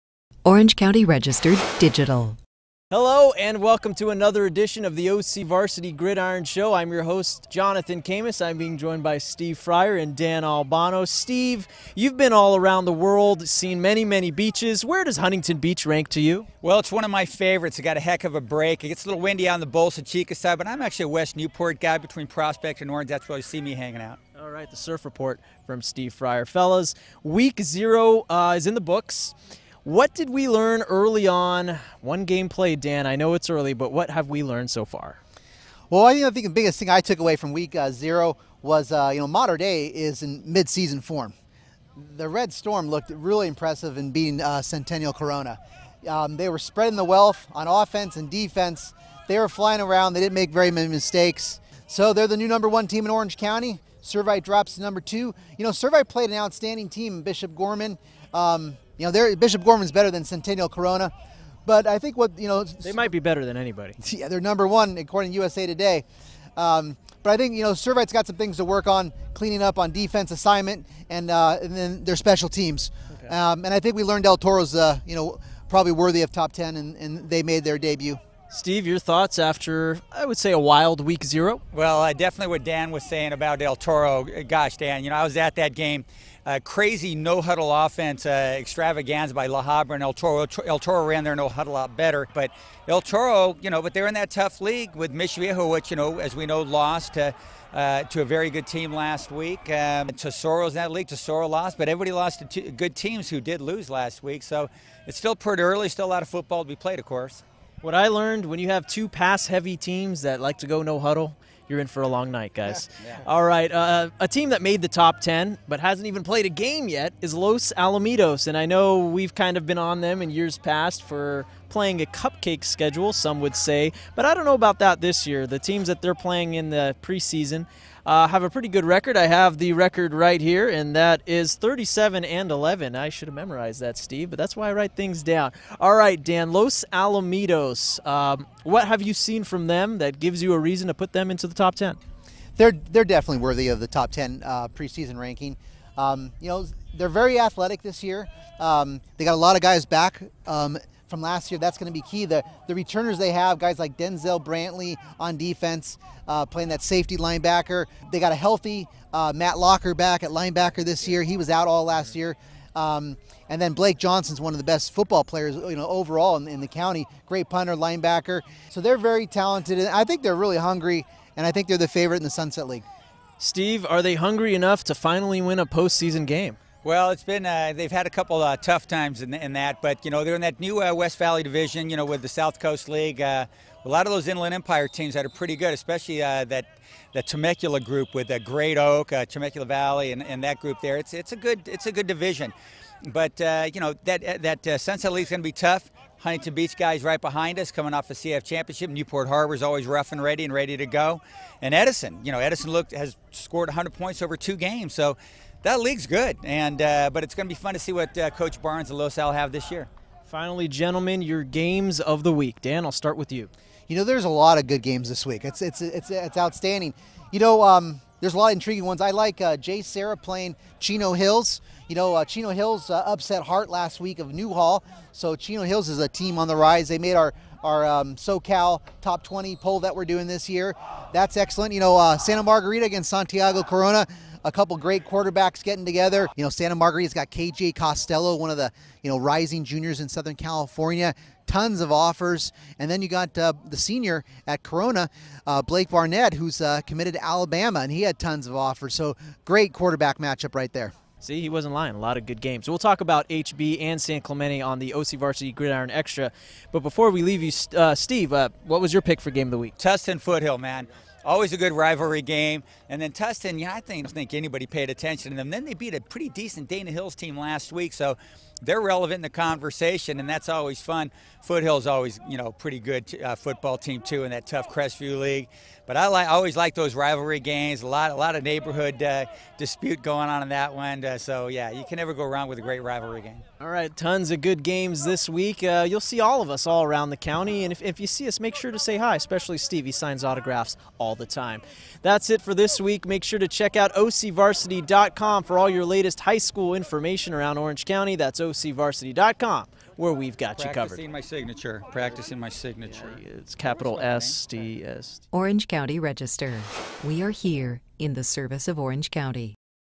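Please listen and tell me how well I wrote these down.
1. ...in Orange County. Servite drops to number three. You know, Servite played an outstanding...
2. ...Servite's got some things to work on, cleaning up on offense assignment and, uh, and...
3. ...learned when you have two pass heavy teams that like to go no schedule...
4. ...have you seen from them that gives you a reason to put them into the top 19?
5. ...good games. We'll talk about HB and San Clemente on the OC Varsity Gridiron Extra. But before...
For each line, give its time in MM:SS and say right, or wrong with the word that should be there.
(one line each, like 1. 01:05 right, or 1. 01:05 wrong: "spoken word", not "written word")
1. 00:53 wrong: "two", not "three"
2. 01:07 wrong: "defense", not "offense"
3. 01:48 wrong: "huddle", not "schedule"
4. 02:18 wrong: "10", not "19"
5. 04:12 right.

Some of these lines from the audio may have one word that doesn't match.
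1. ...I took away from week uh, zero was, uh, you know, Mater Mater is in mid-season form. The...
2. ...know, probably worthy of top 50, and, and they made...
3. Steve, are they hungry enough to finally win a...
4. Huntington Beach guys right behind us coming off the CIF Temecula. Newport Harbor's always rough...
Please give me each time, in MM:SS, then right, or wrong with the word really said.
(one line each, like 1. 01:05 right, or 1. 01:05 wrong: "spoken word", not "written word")
1. 00:36 wrong: "Dei", not "Mater"
2. 01:15 wrong: "10", not "50"
3. 02:53 right
4. 03:16 wrong: "Championship", not "Temecula".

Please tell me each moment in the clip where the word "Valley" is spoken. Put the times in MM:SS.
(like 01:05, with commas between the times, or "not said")
03:01, 03:09.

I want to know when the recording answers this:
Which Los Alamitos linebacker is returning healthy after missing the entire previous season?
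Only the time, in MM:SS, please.
02:39.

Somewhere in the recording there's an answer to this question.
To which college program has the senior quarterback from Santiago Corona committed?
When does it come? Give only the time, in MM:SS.
04:07.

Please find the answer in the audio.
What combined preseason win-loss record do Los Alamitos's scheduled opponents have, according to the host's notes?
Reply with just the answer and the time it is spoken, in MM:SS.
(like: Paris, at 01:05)
37 and 11, at 02:11.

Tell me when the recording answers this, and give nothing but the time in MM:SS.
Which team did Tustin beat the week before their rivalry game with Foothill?
04:26.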